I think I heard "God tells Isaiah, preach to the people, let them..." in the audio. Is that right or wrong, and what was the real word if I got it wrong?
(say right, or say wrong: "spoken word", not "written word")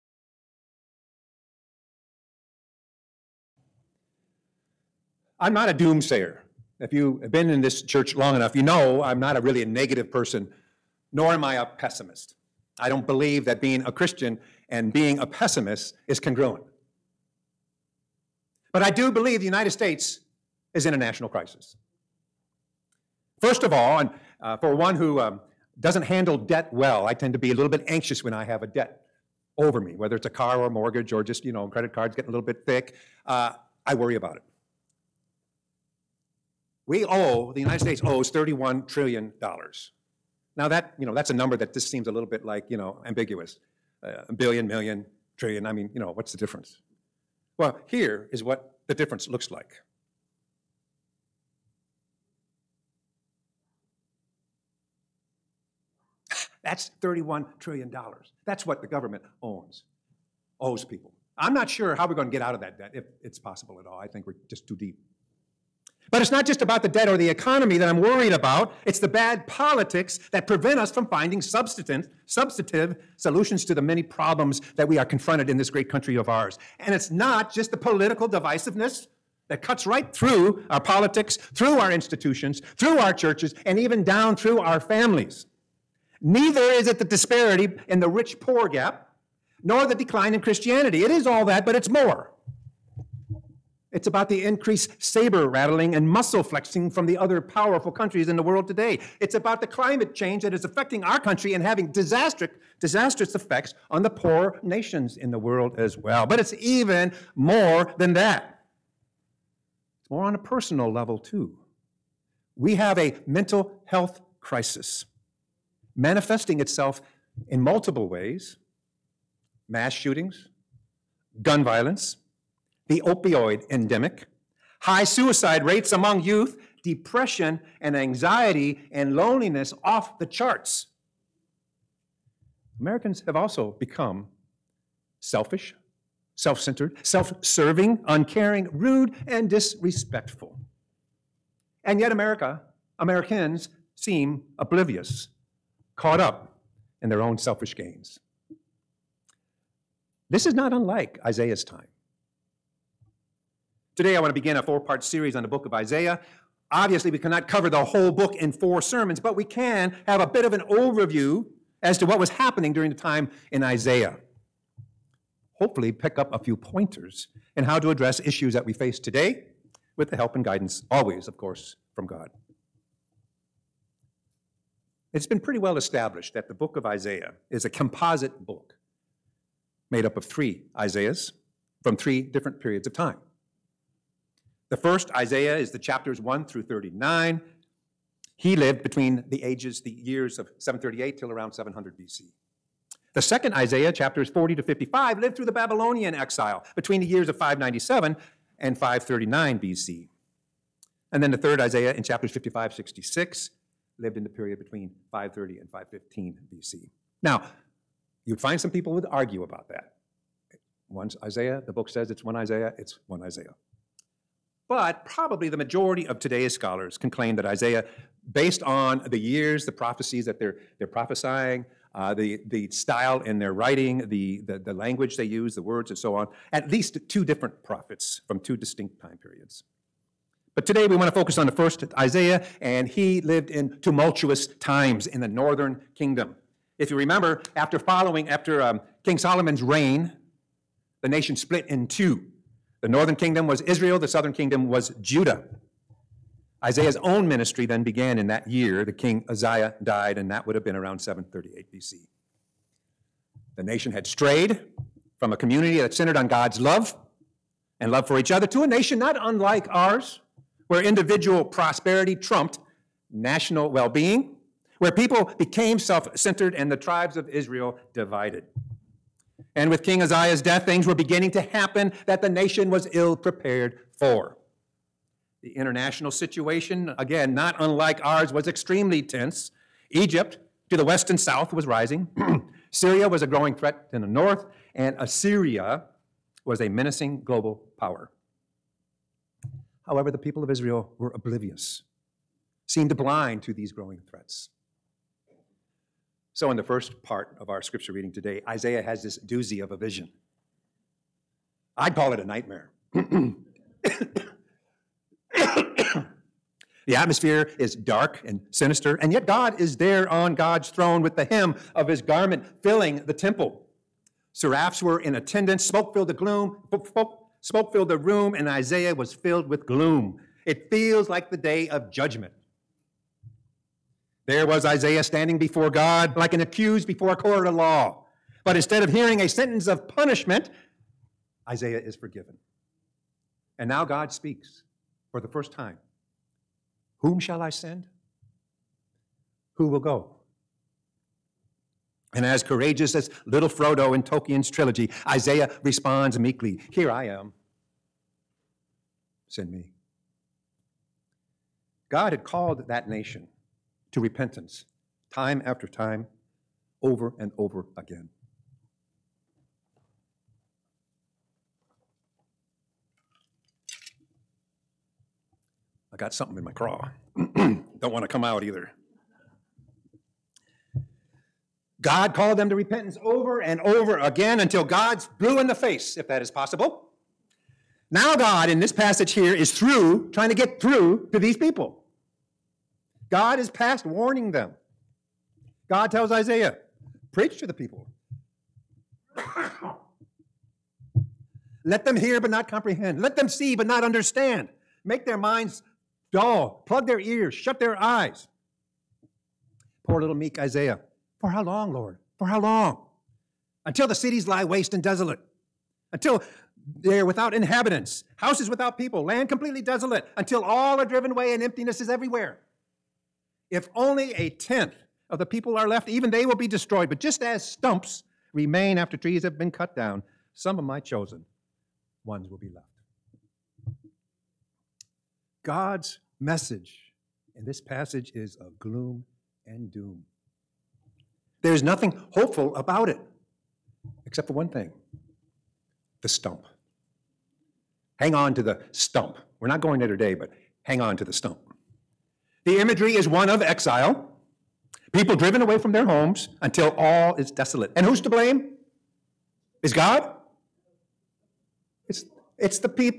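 right.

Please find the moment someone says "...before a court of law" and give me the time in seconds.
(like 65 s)
326 s.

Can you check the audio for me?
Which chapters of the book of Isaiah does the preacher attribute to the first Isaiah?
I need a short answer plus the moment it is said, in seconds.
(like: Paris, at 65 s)
1 through 39, at 185 s.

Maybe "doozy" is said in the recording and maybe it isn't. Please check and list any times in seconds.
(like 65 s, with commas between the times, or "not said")
299 s.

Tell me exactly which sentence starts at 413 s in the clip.
If only a tenth of the people are left, even they will be destroyed.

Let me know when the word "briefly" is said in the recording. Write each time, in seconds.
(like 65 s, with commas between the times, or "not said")
not said.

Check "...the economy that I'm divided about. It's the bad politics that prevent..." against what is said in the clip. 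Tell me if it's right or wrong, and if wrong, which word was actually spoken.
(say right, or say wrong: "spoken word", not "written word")
wrong: "worried", not "divided".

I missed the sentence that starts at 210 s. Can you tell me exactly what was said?
One's Isaiah, the book says it's one Isaiah, it's one Isaiah.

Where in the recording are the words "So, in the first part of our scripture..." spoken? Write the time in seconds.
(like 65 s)
296 s.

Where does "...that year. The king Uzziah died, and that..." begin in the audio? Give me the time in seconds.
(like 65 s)
248 s.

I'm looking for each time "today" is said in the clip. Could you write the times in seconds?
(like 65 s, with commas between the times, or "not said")
98 s, 153 s, 168 s, 216 s, 230 s, 298 s, 439 s.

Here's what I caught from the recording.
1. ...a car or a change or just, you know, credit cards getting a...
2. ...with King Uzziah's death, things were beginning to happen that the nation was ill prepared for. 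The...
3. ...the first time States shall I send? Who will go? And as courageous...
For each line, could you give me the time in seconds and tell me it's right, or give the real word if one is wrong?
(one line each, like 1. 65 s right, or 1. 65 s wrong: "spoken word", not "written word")
1. 30 s wrong: "mortgage", not "change"
2. 269 s right
3. 335 s wrong: "Whom", not "States".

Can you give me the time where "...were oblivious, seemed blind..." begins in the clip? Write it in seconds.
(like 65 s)
290 s.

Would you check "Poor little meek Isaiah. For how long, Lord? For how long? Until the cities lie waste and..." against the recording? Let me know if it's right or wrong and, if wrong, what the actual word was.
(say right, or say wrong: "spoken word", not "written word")
right.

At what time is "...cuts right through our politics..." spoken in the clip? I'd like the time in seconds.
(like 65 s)
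79 s.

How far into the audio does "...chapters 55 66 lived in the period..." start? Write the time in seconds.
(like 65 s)
202 s.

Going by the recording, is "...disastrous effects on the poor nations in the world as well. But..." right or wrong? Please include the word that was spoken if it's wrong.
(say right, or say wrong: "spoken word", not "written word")
right.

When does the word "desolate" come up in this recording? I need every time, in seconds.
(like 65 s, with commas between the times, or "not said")
404 s, 409 s, 447 s.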